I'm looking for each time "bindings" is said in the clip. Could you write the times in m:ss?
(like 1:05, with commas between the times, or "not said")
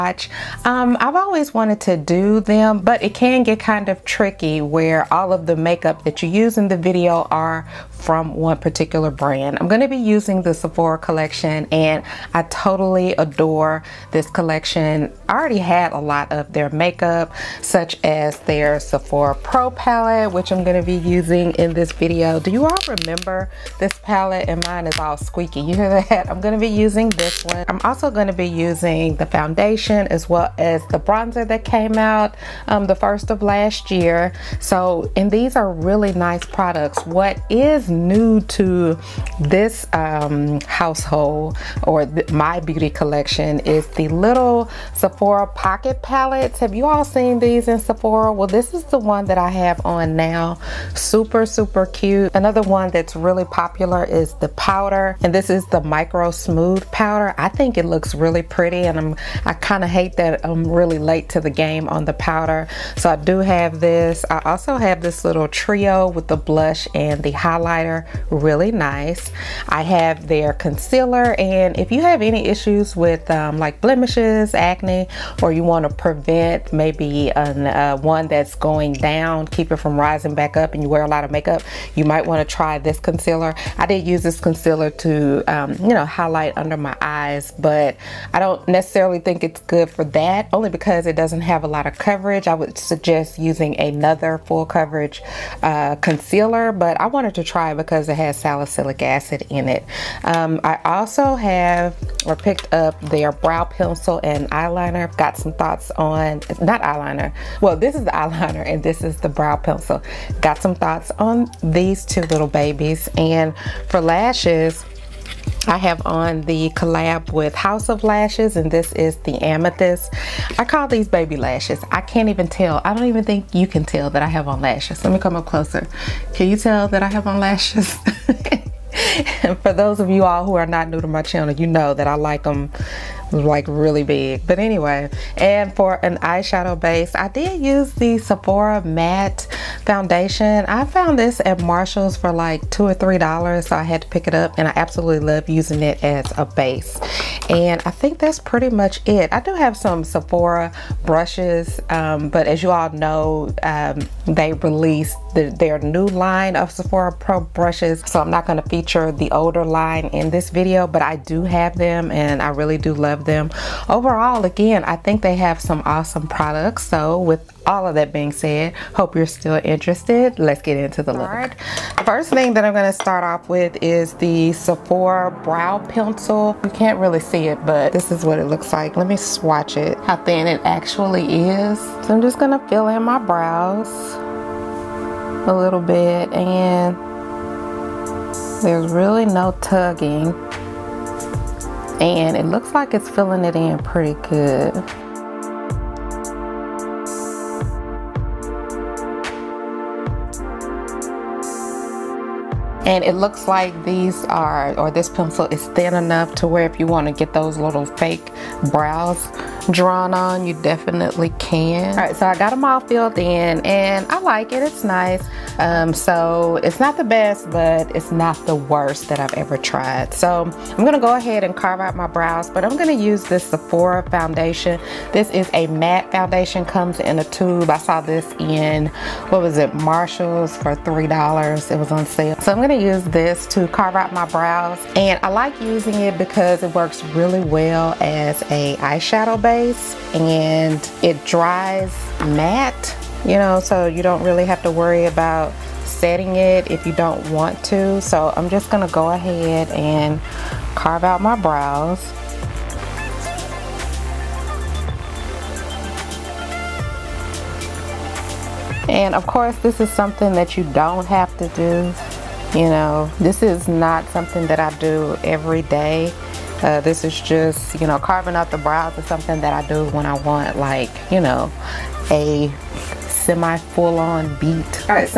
not said.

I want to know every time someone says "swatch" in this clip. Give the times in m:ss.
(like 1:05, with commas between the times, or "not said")
2:59.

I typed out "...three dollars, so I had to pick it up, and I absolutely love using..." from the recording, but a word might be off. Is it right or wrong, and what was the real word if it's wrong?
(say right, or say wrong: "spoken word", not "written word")
right.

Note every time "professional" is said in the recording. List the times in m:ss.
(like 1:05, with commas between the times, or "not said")
not said.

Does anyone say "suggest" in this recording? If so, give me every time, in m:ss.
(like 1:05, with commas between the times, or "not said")
1:32.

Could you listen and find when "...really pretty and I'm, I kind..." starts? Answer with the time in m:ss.
0:58.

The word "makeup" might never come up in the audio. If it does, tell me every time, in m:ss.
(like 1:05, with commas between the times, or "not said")
0:05, 0:16, 1:21.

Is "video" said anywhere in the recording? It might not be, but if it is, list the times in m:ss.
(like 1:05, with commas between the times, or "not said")
0:06, 0:21, 2:40.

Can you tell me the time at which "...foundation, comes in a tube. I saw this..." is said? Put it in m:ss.
3:46.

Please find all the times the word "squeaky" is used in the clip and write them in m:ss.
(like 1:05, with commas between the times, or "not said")
0:25.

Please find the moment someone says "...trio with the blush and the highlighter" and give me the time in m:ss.
1:05.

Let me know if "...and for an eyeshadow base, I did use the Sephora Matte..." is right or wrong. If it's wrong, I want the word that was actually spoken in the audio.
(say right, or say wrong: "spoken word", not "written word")
right.